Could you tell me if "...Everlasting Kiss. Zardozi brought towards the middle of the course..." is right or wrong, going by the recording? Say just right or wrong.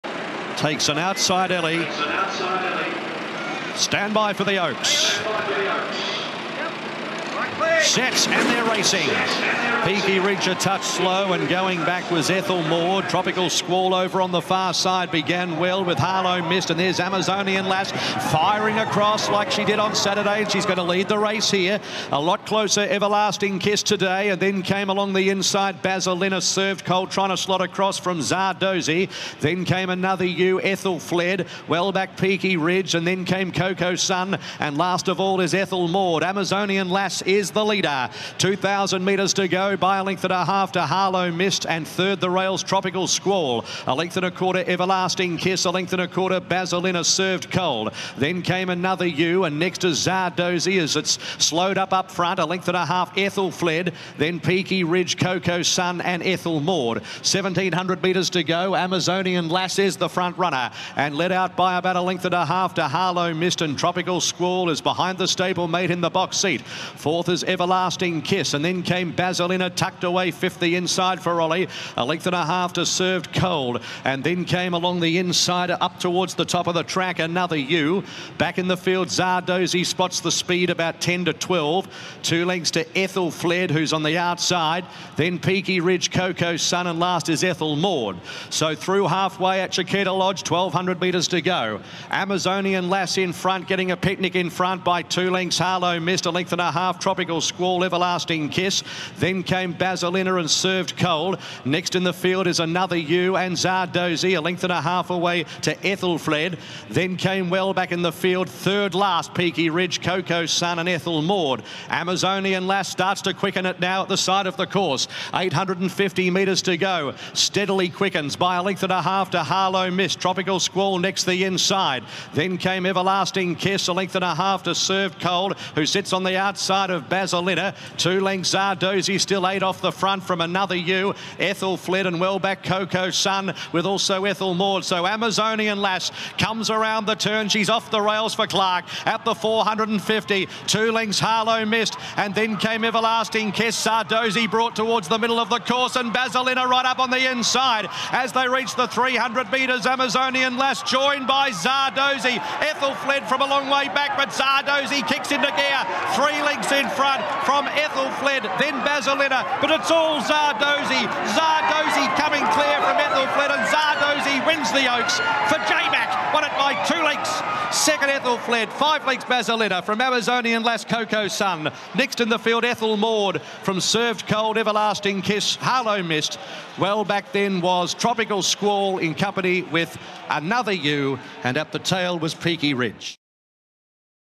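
right.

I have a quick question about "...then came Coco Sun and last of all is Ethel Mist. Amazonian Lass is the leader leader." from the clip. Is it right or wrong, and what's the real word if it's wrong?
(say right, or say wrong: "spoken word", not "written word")
wrong: "Maude", not "Mist".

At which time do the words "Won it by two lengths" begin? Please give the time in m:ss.
2:46.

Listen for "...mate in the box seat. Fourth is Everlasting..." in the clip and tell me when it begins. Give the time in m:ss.
1:05.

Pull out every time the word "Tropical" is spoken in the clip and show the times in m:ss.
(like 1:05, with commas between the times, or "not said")
0:13, 0:42, 1:03, 1:36, 2:00, 2:57.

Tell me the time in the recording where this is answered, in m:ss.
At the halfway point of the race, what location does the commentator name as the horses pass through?
1:29.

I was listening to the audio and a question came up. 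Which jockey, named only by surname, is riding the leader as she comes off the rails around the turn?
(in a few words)
Clark.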